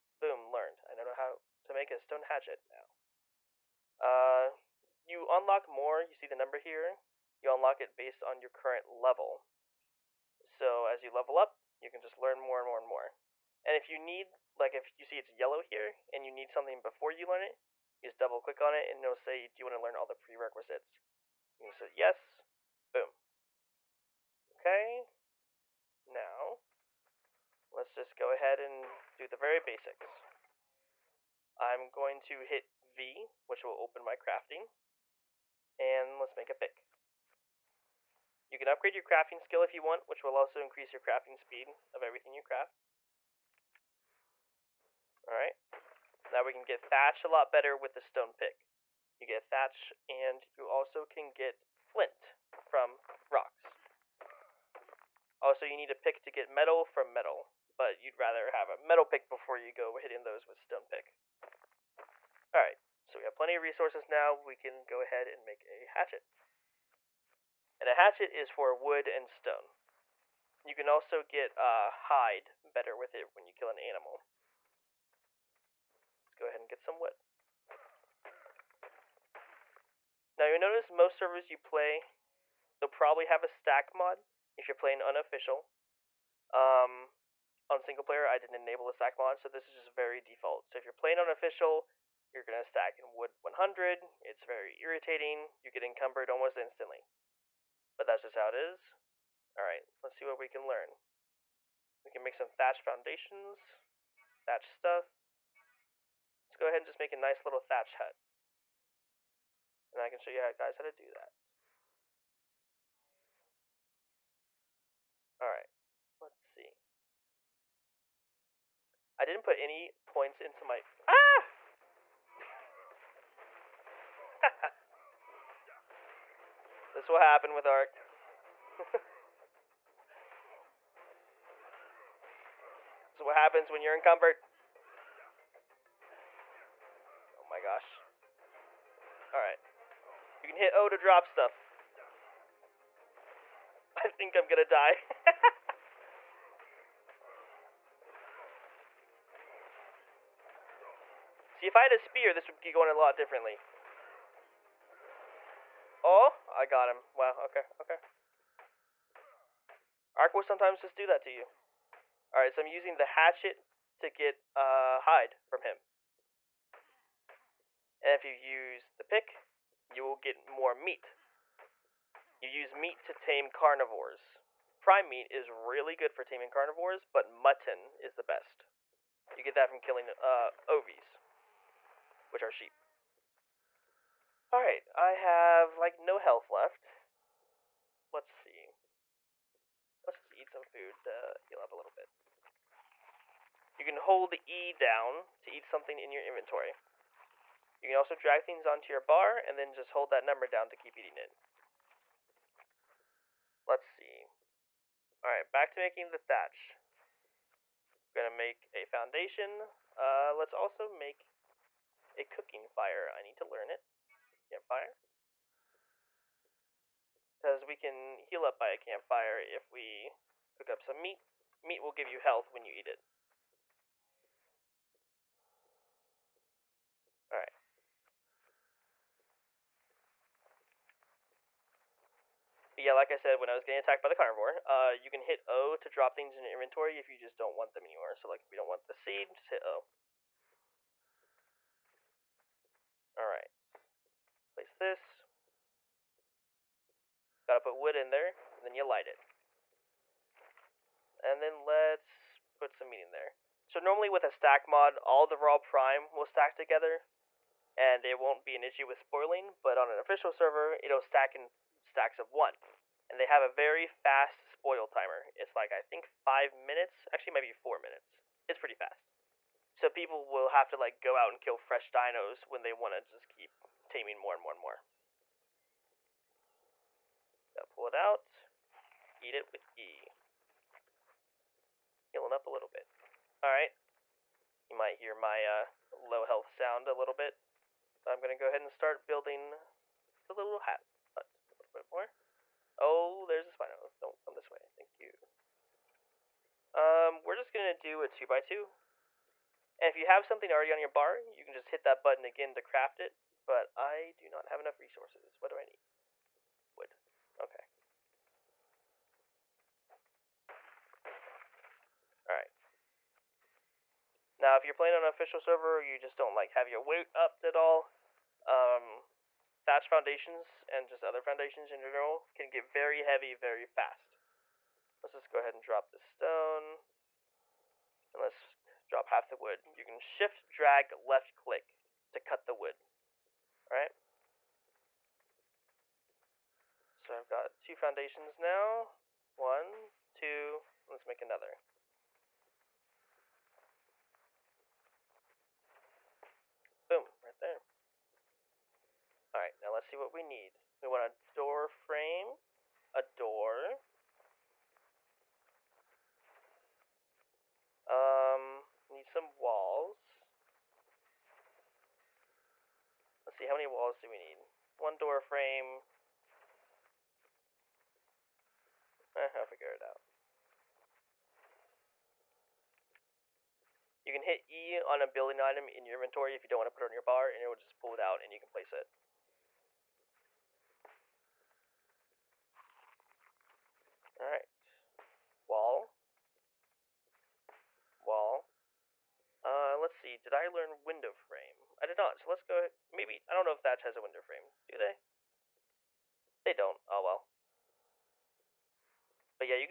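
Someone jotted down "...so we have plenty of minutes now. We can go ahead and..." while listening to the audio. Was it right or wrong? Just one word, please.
wrong.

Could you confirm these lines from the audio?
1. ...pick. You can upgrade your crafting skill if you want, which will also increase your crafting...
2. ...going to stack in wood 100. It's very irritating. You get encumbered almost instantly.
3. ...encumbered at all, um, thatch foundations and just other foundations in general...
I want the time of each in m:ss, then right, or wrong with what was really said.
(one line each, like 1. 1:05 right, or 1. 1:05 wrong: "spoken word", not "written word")
1. 0:36 right
2. 1:32 right
3. 5:17 wrong: "upped", not "encumbered".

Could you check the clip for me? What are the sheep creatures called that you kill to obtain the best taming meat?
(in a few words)
Ovies.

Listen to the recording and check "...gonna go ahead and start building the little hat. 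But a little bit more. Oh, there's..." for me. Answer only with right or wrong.
right.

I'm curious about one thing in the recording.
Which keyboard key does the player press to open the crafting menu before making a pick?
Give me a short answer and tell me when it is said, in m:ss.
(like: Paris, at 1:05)
V, at 0:32.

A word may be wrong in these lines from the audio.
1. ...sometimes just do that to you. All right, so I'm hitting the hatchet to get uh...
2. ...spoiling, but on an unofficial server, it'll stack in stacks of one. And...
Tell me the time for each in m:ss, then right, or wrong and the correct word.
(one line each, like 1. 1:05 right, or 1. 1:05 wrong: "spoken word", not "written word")
1. 2:40 wrong: "using", not "hitting"
2. 4:18 wrong: "official", not "unofficial".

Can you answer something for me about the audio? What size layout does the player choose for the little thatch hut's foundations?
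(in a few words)
Two by two.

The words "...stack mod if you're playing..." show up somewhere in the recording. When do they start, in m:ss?
1:23.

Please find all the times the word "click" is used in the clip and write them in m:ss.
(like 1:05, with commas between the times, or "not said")
0:18, 5:31.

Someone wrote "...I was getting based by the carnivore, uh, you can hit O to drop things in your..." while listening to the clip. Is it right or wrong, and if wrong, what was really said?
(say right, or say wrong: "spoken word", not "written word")
wrong: "attacked", not "based".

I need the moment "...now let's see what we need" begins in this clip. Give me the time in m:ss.
5:49.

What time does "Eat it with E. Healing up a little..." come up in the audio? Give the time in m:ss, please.
4:39.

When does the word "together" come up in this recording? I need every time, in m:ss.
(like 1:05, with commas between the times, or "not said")
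4:16.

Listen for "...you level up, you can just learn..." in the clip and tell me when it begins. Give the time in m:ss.
0:11.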